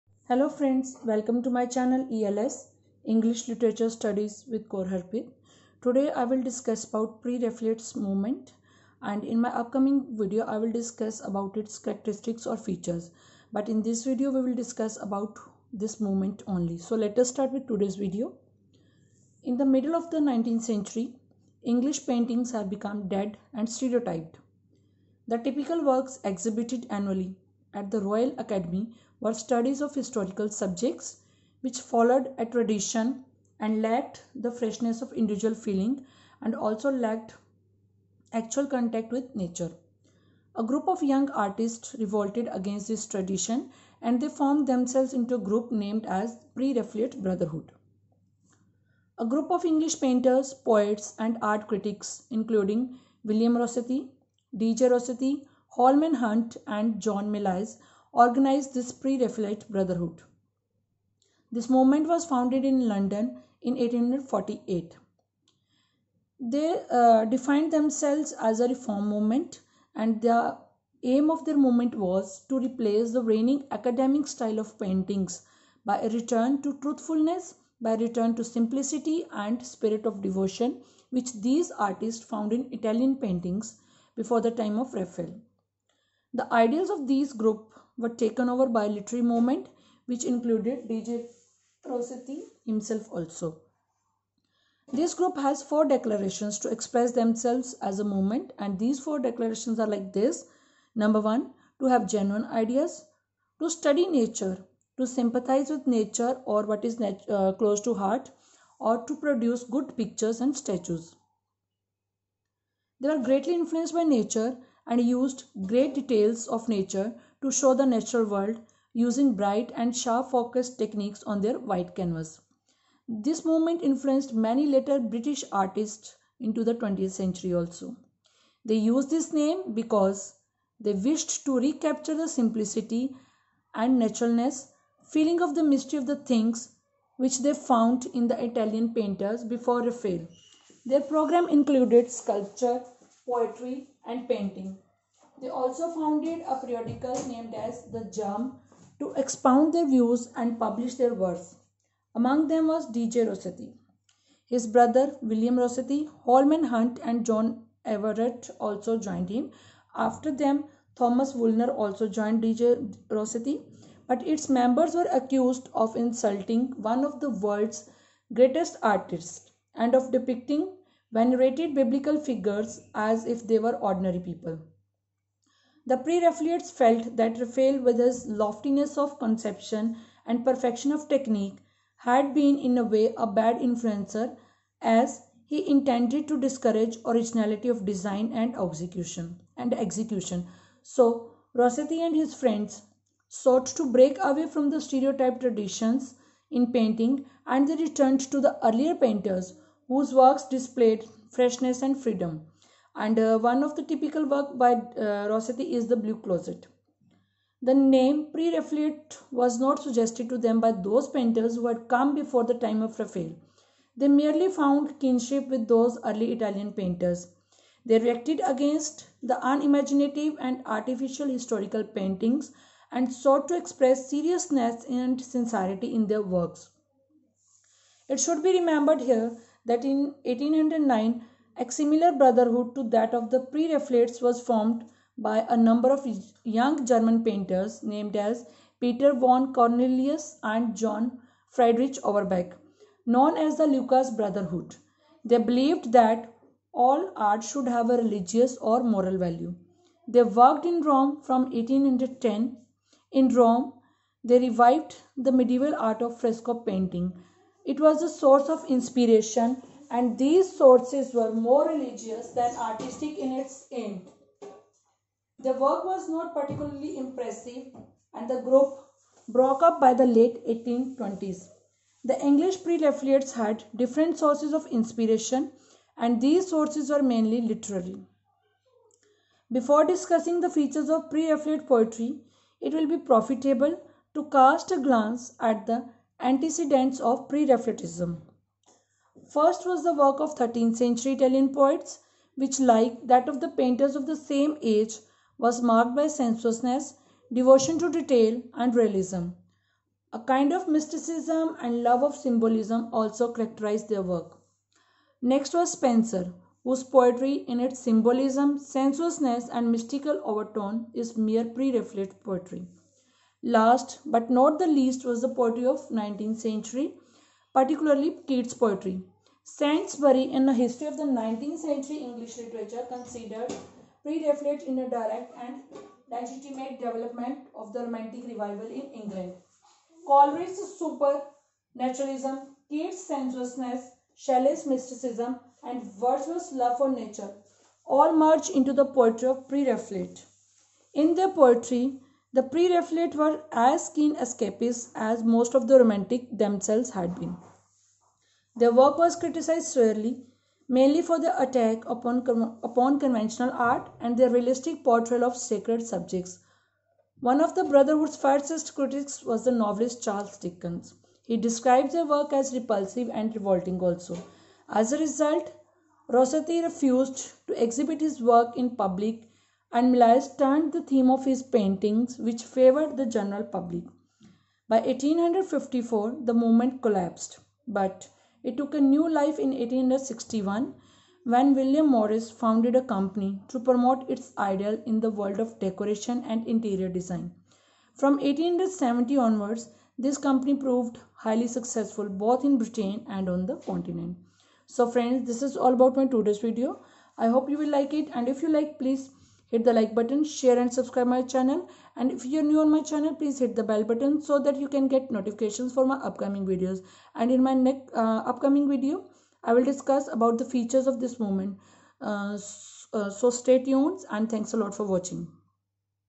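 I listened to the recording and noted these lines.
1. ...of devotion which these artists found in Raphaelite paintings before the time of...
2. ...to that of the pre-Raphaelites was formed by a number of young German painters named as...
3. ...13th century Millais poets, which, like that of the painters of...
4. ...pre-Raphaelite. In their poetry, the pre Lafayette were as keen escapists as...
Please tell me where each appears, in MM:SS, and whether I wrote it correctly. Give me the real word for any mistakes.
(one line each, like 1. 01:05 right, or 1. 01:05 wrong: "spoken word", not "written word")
1. 01:20 wrong: "Italian", not "Raphaelite"
2. 03:52 right
3. 04:50 wrong: "Italian", not "Millais"
4. 05:39 wrong: "Raphaelites", not "Lafayette".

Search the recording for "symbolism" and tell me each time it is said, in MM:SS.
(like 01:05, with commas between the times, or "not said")
05:02, 05:07.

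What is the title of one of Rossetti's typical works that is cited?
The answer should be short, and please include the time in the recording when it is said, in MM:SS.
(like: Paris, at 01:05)
The Blue Closet, at 03:25.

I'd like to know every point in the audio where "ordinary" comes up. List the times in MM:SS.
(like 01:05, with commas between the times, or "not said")
02:53.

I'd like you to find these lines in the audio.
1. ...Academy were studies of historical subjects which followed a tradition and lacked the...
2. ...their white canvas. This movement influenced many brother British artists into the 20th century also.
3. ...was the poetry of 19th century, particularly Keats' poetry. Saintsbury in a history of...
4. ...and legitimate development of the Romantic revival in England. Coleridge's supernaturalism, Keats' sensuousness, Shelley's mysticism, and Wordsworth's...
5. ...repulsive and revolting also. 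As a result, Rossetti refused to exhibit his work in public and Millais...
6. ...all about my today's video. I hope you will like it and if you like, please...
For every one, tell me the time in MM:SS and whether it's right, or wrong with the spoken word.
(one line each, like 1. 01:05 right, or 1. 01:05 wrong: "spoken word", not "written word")
1. 00:28 right
2. 02:01 wrong: "later", not "brother"
3. 05:15 right
4. 05:25 right
5. 06:02 right
6. 06:35 right.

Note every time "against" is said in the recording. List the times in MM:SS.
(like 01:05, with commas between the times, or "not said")
00:42, 03:38.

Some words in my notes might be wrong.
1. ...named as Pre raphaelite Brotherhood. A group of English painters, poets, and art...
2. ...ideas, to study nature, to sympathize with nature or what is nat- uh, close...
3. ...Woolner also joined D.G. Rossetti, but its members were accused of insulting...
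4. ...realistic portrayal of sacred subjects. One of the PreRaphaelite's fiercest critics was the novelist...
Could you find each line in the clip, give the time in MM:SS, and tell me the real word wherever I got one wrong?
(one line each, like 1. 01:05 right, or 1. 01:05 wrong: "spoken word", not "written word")
1. 00:45 right
2. 01:42 right
3. 02:41 right
4. 05:54 wrong: "Brotherhood", not "PreRaphaelite".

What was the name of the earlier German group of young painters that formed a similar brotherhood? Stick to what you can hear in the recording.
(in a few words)
Lucas Brotherhood.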